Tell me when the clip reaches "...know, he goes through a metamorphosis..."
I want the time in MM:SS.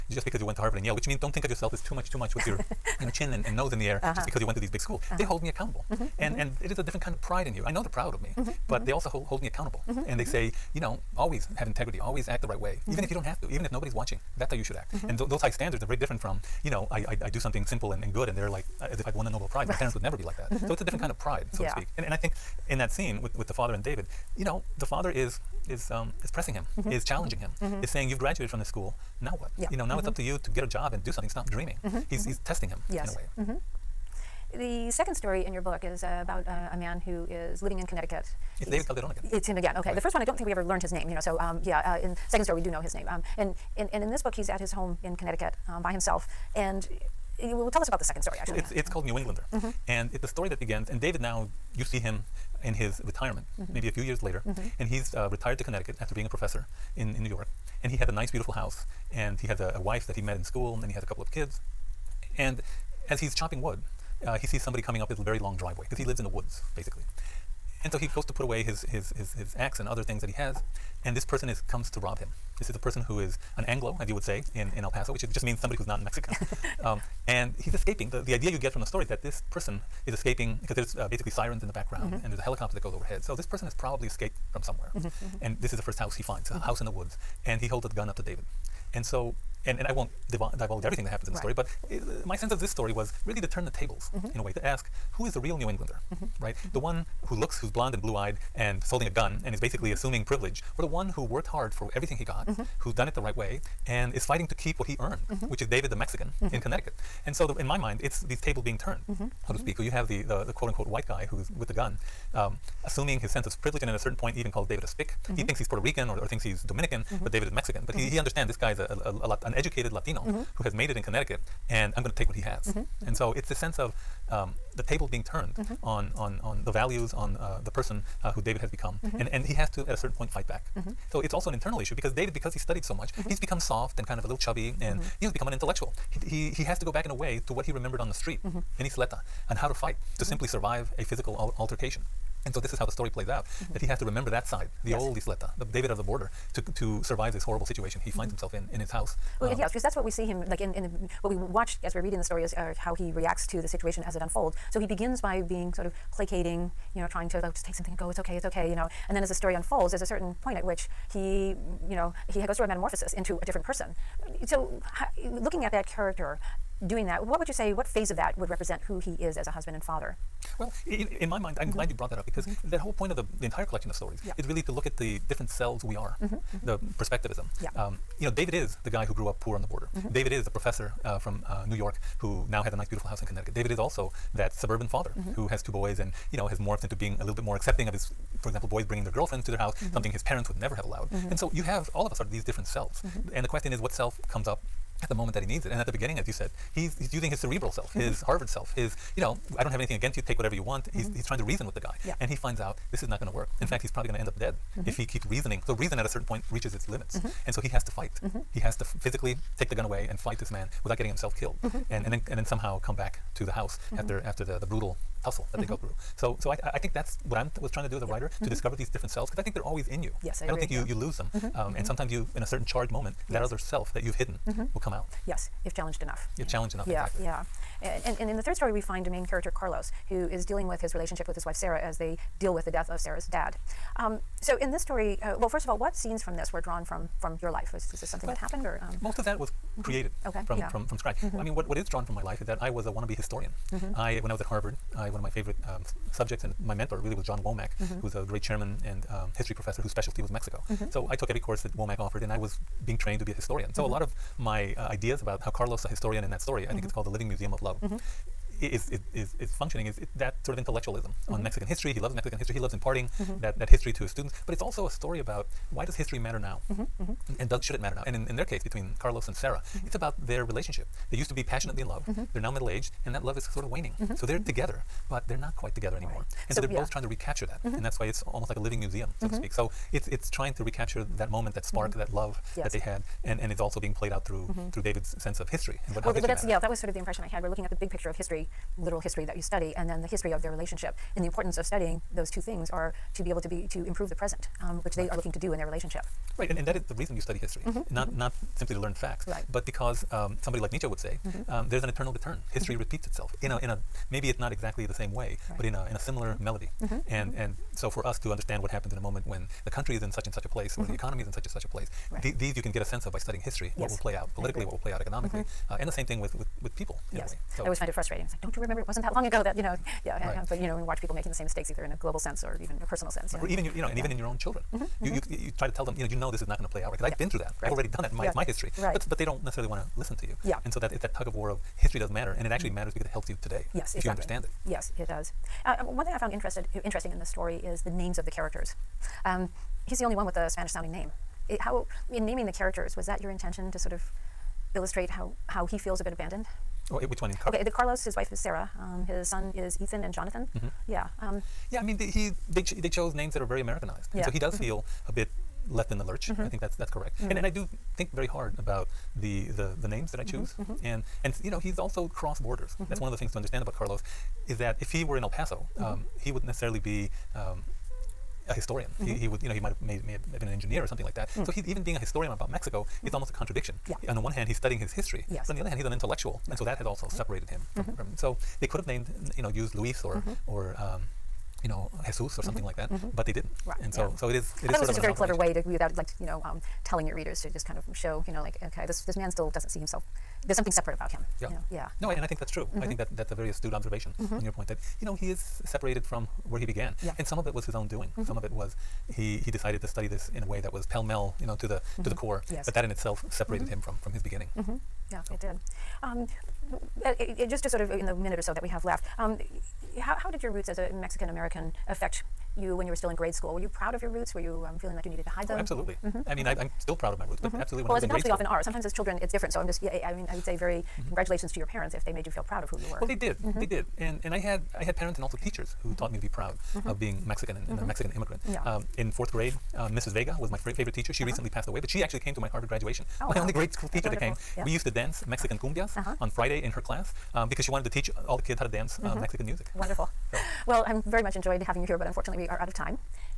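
02:41.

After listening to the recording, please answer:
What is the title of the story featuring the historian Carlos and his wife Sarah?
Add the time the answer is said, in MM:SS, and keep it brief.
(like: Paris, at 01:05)
The Living Museum of Love, at 04:17.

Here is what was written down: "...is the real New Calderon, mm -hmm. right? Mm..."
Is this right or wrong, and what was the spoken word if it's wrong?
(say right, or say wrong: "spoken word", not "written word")
wrong: "Englander", not "Calderon".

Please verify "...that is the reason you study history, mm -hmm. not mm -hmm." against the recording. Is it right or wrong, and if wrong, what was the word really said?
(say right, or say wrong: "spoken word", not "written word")
right.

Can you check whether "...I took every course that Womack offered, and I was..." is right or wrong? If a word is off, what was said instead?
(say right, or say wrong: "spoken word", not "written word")
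right.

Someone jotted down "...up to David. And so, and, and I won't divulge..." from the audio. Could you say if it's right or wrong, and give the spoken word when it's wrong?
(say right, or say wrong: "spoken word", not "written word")
right.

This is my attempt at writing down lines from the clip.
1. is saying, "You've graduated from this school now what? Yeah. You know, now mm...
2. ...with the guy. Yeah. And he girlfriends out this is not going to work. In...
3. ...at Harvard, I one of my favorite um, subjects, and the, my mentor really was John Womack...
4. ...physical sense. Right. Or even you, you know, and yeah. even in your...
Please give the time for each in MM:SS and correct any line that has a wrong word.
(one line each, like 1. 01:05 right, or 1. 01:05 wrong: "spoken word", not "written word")
1. 00:27 right
2. 03:21 wrong: "finds", not "girlfriends"
3. 04:04 right
4. 05:22 wrong: "personal", not "physical".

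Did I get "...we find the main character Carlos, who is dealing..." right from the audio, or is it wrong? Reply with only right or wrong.
right.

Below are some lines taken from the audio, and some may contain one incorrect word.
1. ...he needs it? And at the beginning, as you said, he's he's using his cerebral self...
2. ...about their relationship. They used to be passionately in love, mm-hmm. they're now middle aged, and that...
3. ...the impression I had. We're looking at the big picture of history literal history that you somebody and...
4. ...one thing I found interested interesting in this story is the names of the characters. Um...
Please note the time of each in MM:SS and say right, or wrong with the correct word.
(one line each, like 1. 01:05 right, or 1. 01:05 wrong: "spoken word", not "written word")
1. 03:15 right
2. 04:29 right
3. 04:46 wrong: "study", not "somebody"
4. 05:35 right.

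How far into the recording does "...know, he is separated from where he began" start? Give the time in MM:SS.
06:35.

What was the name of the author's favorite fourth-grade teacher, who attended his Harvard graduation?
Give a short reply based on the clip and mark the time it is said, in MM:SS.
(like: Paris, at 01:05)
Mrs. Vega, at 07:09.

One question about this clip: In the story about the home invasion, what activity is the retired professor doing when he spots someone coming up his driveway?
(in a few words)
Chopping wood.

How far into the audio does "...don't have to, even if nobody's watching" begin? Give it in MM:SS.
00:13.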